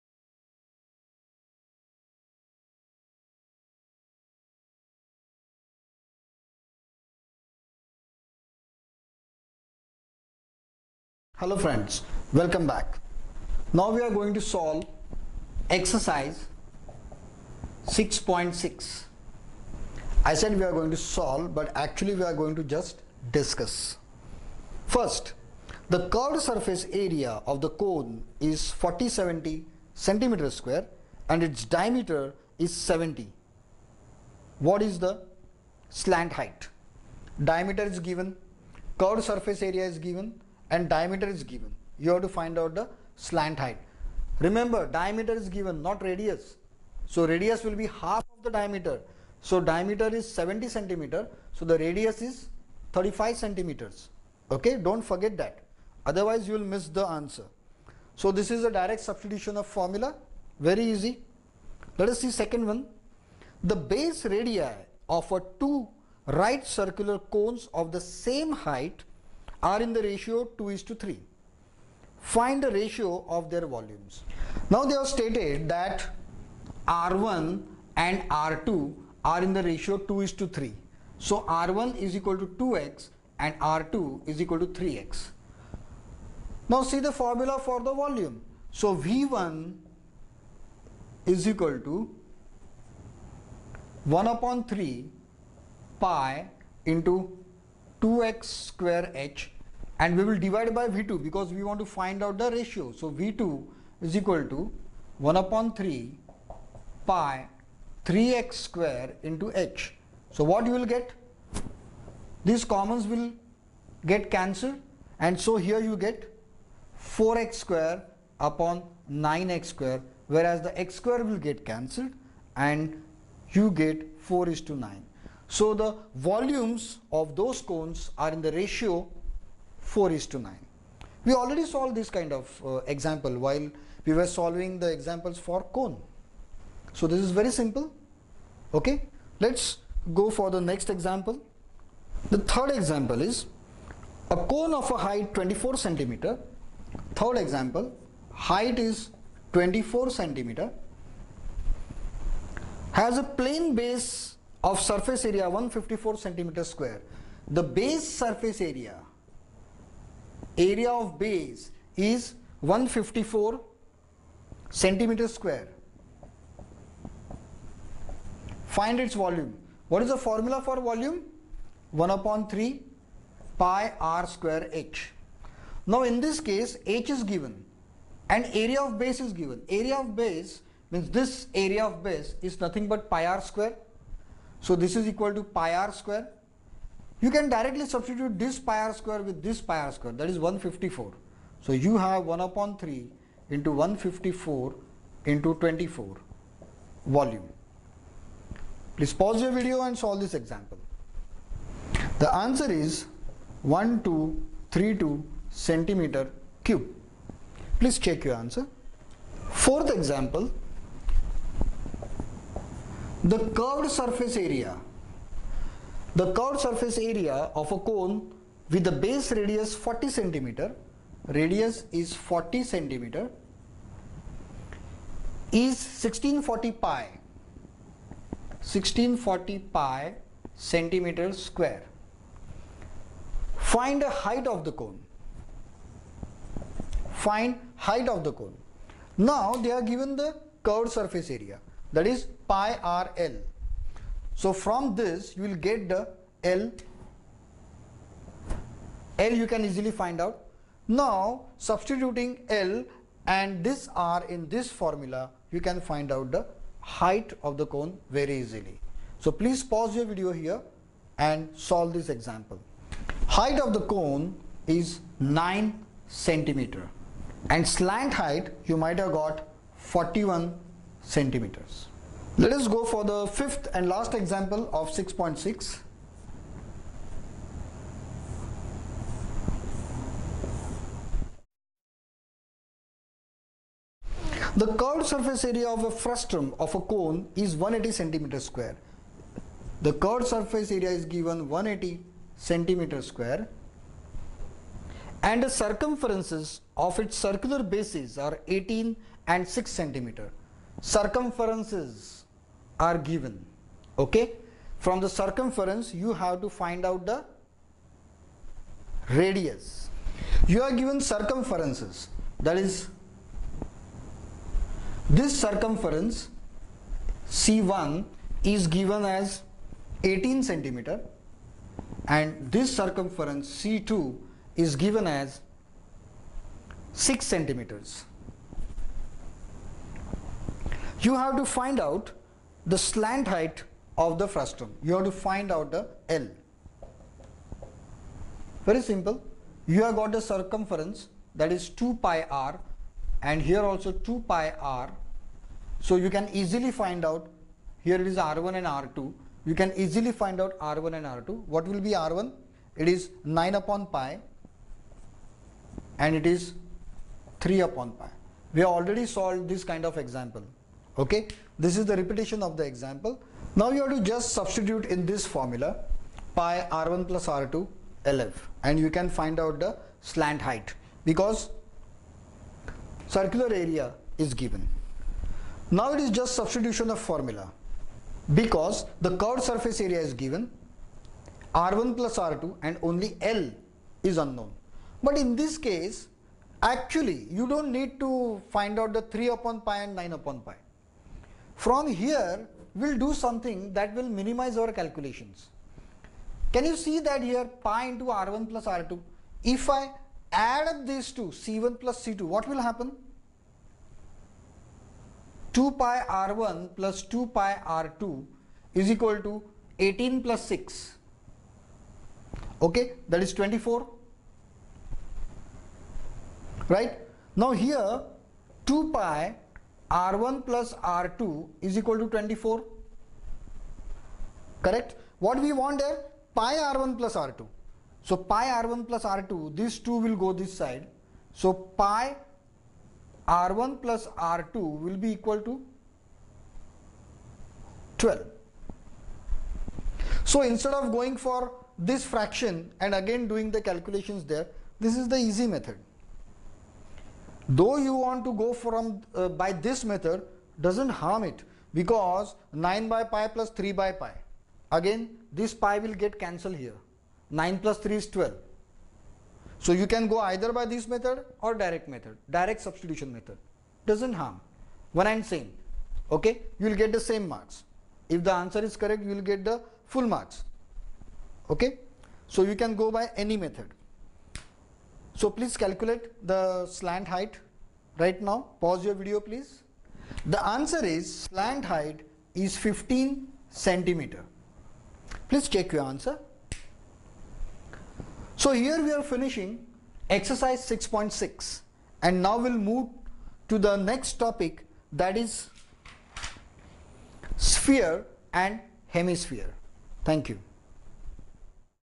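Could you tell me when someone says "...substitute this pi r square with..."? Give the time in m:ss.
3:07.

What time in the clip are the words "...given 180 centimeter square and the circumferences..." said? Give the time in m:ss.
4:51.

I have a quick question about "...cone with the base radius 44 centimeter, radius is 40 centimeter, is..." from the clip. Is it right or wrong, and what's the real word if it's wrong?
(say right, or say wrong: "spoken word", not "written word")
wrong: "40", not "44".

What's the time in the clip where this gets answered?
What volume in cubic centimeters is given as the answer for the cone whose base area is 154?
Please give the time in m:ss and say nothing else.
3:23.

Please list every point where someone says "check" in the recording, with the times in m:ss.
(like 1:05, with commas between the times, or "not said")
3:28, 8:05.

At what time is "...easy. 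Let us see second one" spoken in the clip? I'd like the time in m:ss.
1:00.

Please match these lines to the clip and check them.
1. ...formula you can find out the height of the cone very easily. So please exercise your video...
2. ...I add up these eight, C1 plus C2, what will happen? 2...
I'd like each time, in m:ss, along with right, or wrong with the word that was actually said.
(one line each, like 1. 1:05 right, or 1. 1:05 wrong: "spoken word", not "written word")
1. 4:14 wrong: "pause", not "exercise"
2. 6:39 wrong: "two", not "eight".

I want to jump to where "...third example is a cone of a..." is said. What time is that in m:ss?
2:22.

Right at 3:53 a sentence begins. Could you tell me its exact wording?
Find the height of the cone.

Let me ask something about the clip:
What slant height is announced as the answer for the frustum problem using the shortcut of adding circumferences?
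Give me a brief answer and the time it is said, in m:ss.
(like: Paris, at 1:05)
15 centimeters, at 8:01.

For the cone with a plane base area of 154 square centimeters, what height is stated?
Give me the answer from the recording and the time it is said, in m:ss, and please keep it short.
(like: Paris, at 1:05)
24 centimeters, at 2:28.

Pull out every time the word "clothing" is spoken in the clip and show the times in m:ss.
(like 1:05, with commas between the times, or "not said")
not said.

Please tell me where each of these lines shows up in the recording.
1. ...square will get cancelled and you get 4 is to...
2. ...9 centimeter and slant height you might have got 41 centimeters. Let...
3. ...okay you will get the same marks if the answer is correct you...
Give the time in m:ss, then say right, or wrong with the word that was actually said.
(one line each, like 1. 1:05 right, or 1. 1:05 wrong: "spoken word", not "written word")
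1. 2:00 right
2. 4:25 right
3. 7:46 right.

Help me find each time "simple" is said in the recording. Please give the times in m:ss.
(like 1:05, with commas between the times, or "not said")
2:17, 5:38.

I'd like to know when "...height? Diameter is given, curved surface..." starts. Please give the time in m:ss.
0:36.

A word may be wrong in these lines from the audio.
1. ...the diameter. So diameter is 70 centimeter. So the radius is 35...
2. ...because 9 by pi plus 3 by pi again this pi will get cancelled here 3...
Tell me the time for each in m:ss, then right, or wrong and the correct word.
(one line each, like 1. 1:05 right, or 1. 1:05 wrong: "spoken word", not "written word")
1. 0:48 right
2. 7:31 wrong: "9", not "3".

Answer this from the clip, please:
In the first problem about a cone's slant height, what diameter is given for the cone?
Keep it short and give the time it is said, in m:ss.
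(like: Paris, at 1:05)
70, at 0:31.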